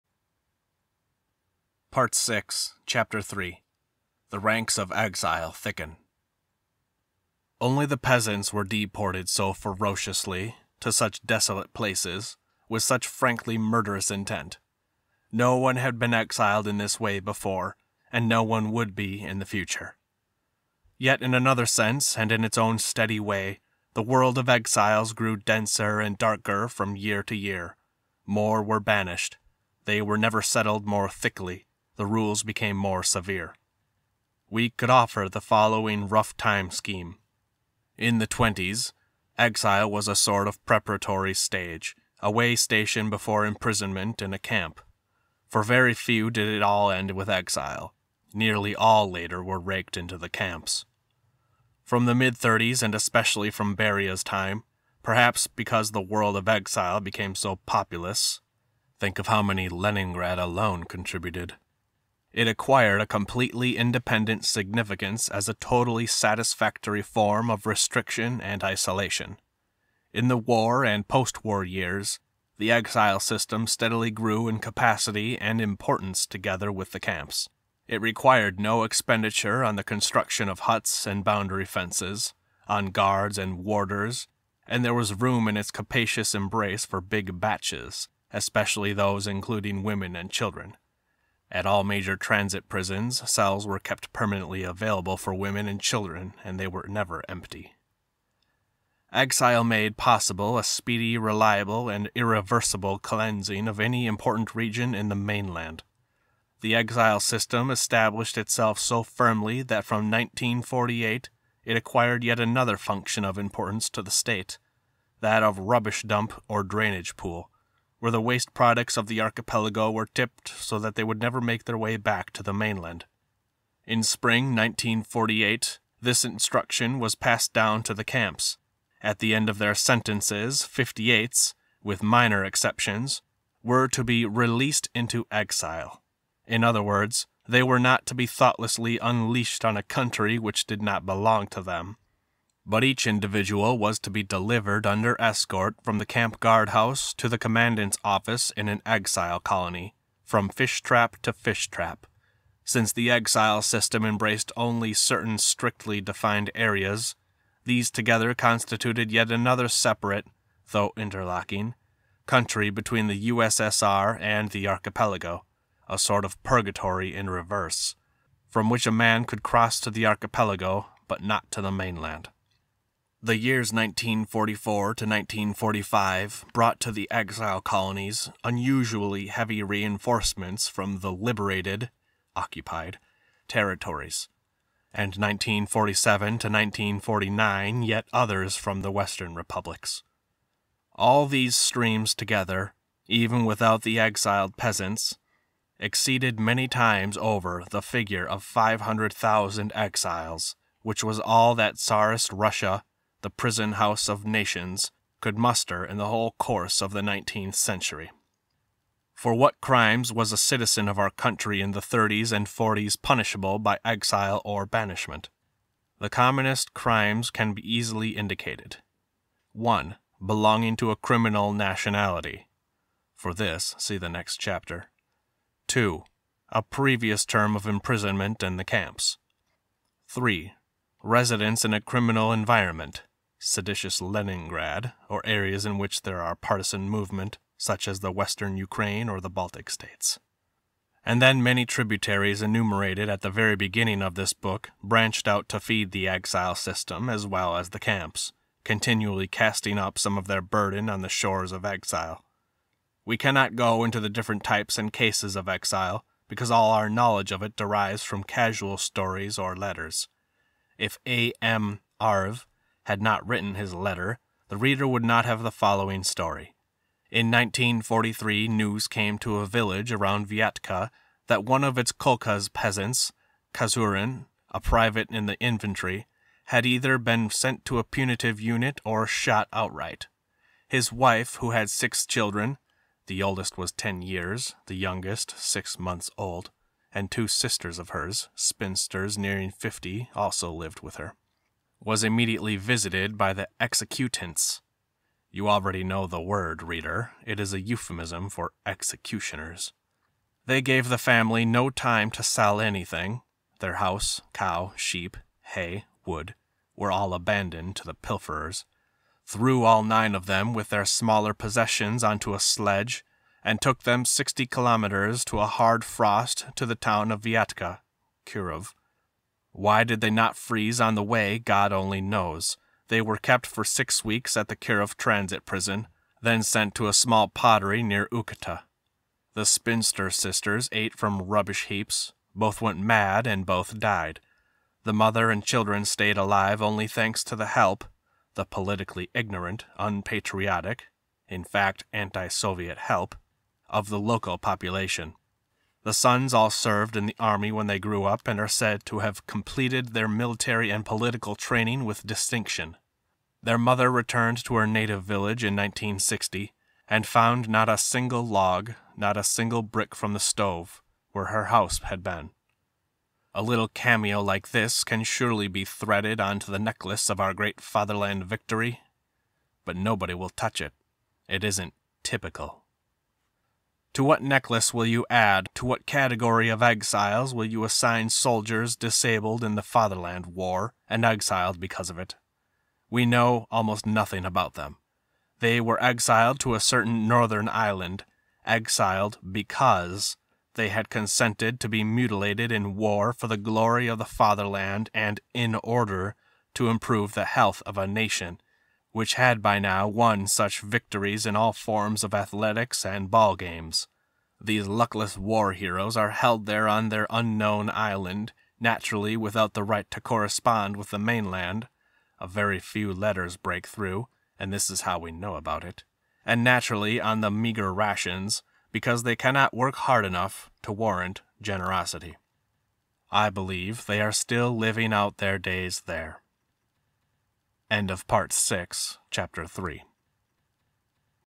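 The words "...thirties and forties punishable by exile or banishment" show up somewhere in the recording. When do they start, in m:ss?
3:31.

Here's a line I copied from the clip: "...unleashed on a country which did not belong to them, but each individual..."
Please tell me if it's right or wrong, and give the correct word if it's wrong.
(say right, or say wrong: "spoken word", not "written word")
right.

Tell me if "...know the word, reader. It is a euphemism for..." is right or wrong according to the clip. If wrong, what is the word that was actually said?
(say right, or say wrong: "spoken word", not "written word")
right.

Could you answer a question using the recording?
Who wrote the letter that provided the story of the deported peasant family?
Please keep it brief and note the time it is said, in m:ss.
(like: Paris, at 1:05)
A. M. Arv, at 4:21.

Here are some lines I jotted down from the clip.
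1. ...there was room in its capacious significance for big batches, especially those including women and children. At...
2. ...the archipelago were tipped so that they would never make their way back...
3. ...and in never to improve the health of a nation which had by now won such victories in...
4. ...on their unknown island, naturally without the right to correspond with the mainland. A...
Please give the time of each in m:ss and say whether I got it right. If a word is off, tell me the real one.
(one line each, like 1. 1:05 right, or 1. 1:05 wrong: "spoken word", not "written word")
1. 1:24 wrong: "embrace", not "significance"
2. 1:59 right
3. 6:34 wrong: "order", not "never"
4. 6:46 right.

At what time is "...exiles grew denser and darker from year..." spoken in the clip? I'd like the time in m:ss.
0:24.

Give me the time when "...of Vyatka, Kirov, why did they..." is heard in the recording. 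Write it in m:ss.
5:17.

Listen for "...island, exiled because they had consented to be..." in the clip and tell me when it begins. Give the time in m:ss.
6:27.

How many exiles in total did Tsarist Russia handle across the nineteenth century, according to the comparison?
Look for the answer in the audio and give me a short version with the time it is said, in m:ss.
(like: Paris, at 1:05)
500,000, at 3:18.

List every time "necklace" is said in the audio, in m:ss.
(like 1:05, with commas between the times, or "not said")
6:06, 6:14.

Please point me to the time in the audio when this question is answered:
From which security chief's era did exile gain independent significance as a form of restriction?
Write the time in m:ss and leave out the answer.
0:53.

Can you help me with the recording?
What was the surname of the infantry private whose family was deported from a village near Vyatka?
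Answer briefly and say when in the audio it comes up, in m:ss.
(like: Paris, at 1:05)
Kazurin, at 4:33.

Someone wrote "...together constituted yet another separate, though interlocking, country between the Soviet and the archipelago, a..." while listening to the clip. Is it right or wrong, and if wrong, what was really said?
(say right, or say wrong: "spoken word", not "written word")
wrong: "USSR", not "Soviet".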